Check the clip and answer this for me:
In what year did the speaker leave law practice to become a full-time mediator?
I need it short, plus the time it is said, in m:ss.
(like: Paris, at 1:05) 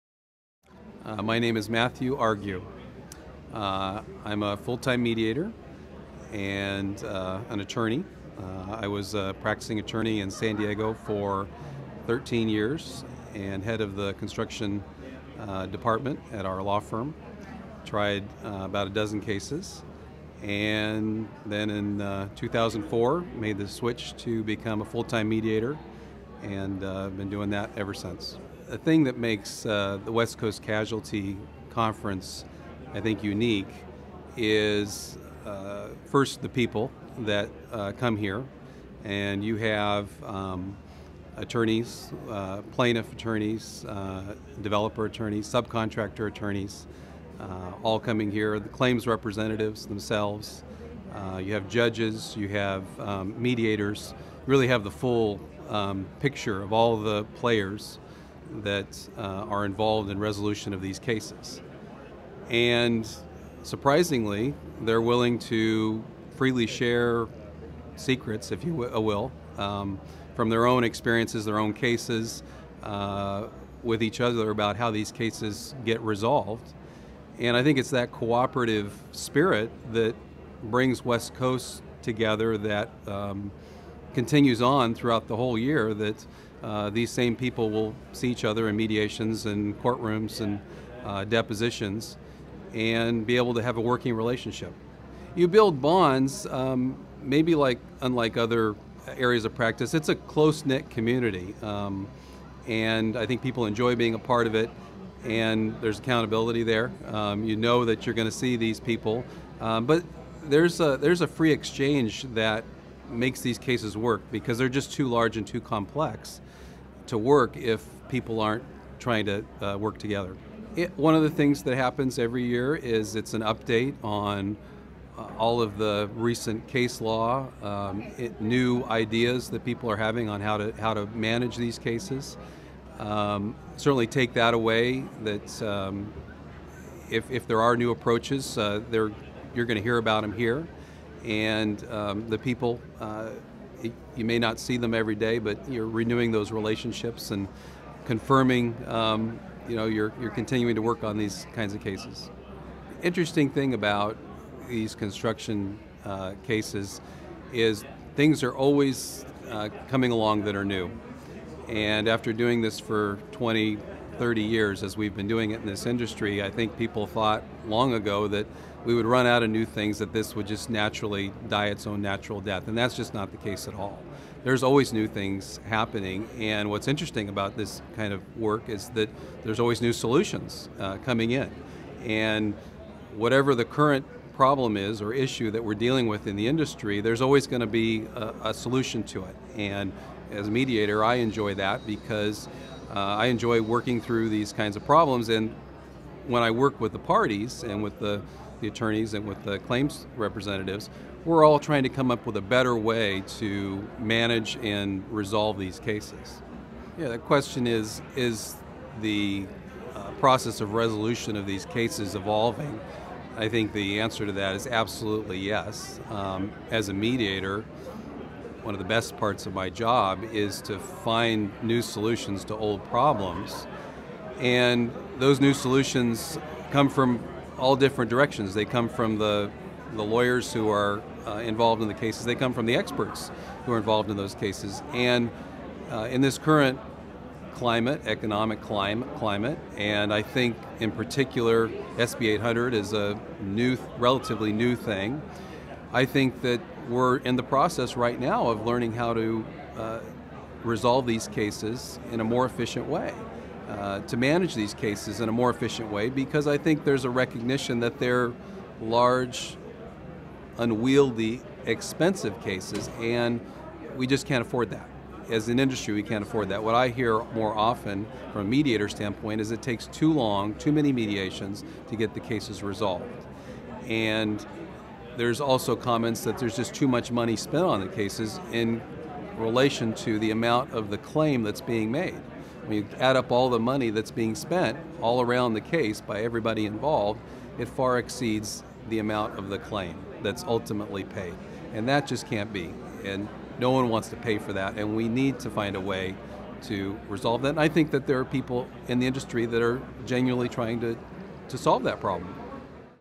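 2004, at 0:22.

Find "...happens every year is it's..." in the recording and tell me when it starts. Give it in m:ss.
2:01.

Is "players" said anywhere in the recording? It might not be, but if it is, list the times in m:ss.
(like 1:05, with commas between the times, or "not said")
0:57.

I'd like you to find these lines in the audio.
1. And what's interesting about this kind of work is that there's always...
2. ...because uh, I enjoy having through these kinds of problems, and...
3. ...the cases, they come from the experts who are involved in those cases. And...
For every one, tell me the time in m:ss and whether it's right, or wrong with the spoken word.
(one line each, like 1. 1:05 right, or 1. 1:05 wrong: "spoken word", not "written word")
1. 2:56 right
2. 3:11 wrong: "working", not "having"
3. 3:51 right.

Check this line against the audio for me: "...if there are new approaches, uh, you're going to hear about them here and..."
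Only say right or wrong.
right.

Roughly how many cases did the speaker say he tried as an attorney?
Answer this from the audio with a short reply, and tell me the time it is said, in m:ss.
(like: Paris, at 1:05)
About a dozen, at 0:18.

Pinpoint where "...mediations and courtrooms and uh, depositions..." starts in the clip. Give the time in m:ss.
1:28.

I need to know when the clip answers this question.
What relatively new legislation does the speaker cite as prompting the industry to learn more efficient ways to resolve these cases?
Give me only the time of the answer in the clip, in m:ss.
4:01.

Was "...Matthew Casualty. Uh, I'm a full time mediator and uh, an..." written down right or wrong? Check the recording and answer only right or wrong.
wrong.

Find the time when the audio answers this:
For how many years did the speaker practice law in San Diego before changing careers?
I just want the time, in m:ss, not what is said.
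0:12.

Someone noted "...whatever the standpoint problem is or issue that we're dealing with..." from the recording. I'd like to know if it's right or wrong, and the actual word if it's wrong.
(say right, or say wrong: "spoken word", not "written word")
wrong: "current", not "standpoint".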